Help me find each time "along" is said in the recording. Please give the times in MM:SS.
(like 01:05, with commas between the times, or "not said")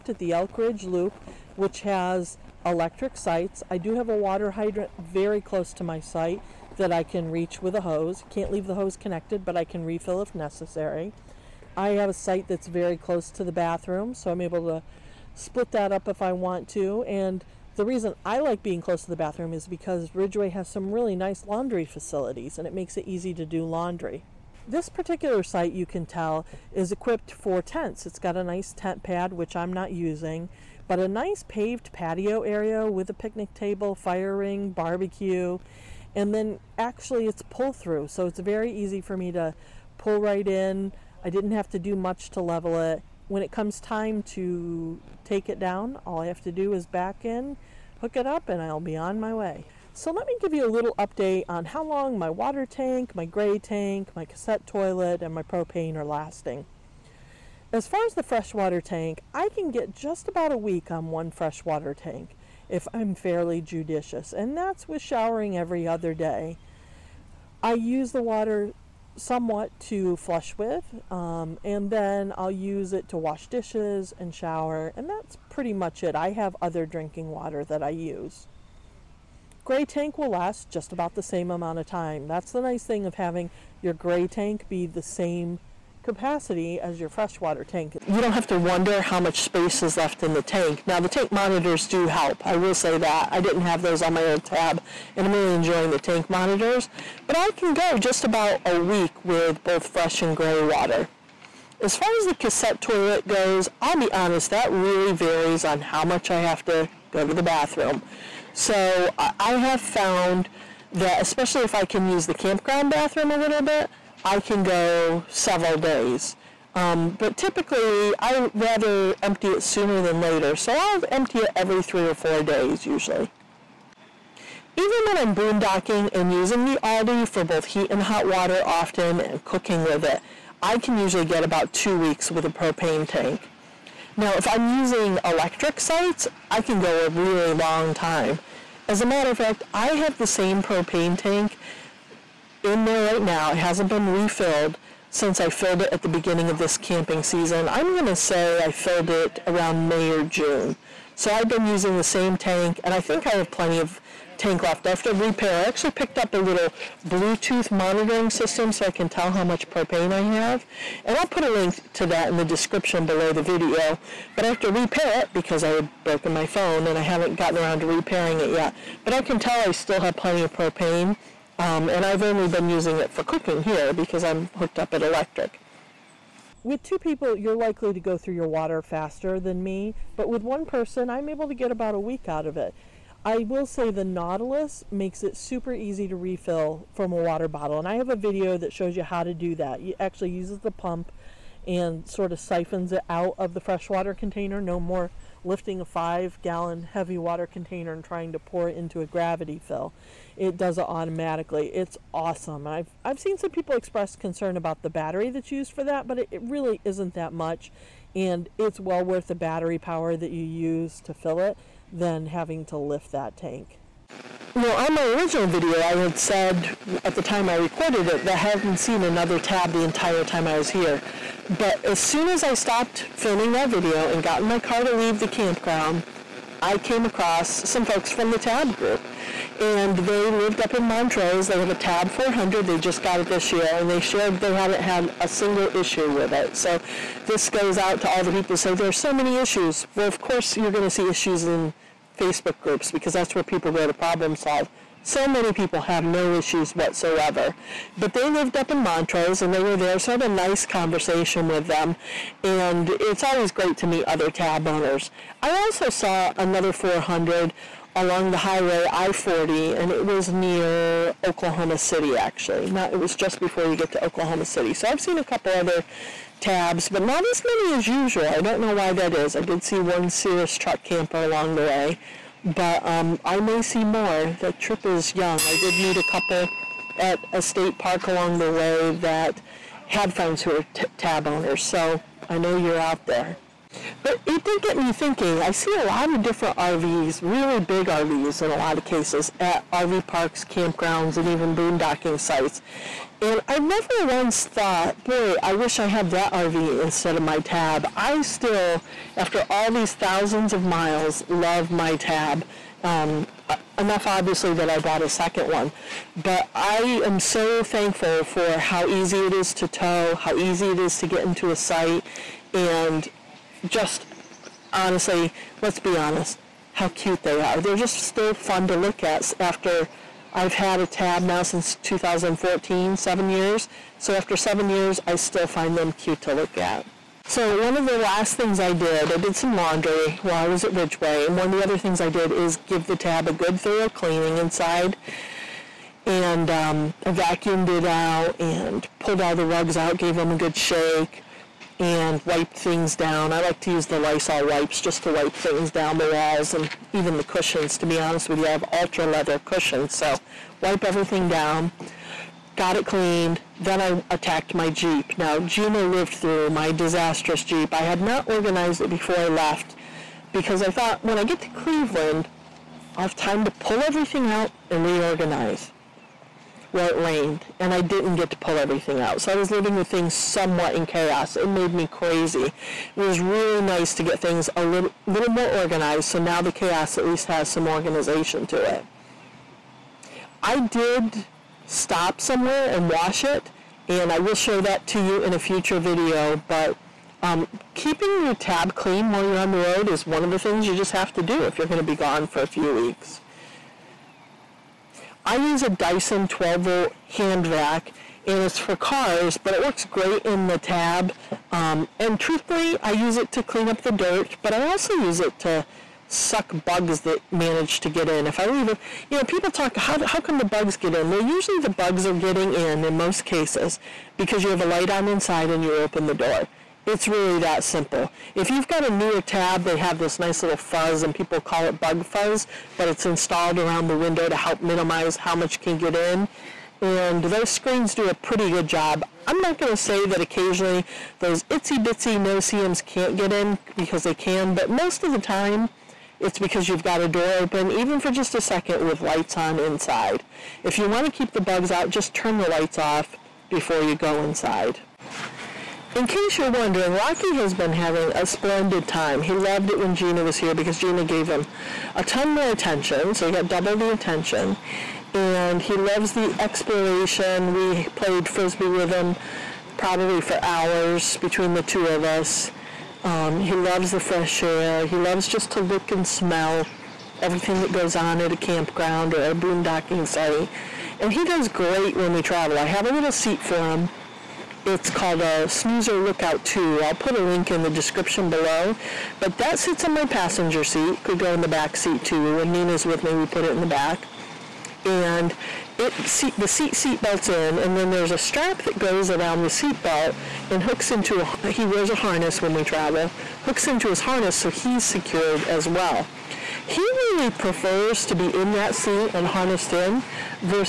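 04:17, 04:31, 04:38.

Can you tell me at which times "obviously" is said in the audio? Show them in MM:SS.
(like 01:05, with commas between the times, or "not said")
05:04.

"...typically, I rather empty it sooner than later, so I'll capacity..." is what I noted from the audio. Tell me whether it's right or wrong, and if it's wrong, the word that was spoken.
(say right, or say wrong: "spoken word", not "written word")
wrong: "empty", not "capacity".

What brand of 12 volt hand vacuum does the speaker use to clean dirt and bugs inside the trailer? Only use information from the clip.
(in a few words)
Dyson.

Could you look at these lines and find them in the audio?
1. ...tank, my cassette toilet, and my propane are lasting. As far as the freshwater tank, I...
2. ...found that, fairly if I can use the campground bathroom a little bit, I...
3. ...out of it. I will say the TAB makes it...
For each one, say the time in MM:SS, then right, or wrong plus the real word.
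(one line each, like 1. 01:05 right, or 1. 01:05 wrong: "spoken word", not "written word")
1. 00:53 right
2. 01:49 wrong: "especially", not "fairly"
3. 03:02 wrong: "Nautilus", not "TAB".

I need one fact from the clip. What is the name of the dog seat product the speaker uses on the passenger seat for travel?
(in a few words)
Snoozer Lookout 2.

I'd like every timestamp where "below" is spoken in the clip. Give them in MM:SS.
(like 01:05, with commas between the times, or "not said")
02:43, 07:58.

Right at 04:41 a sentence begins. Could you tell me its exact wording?
So I know you're out there.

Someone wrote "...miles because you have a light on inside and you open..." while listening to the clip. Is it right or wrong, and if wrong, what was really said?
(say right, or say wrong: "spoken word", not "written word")
wrong: "cases", not "miles".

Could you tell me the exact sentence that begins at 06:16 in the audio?
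So now the chaos at least has some organization to it.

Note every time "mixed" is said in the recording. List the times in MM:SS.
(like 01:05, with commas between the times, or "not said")
not said.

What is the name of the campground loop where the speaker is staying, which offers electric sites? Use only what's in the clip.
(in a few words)
Elk Ridge Loop.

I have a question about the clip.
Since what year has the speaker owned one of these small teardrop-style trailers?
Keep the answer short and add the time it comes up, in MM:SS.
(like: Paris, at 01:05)
2014, at 05:21.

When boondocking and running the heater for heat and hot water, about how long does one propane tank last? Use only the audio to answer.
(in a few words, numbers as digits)
2 weeks.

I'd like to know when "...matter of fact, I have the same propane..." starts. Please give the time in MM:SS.
02:19.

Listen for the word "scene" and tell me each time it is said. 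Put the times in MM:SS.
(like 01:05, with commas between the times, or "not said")
not said.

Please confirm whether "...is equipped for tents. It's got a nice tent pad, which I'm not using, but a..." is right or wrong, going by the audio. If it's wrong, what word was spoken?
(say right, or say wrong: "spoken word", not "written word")
right.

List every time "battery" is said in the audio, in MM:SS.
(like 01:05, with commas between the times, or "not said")
03:24, 03:29.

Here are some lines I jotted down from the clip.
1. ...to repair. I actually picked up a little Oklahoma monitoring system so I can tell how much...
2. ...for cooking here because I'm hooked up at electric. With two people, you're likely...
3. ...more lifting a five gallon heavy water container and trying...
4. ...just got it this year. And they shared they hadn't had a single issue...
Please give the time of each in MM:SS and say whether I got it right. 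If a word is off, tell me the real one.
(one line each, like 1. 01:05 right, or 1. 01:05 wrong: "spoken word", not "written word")
1. 02:35 wrong: "Bluetooth", not "Oklahoma"
2. 02:53 right
3. 03:14 right
4. 03:52 right.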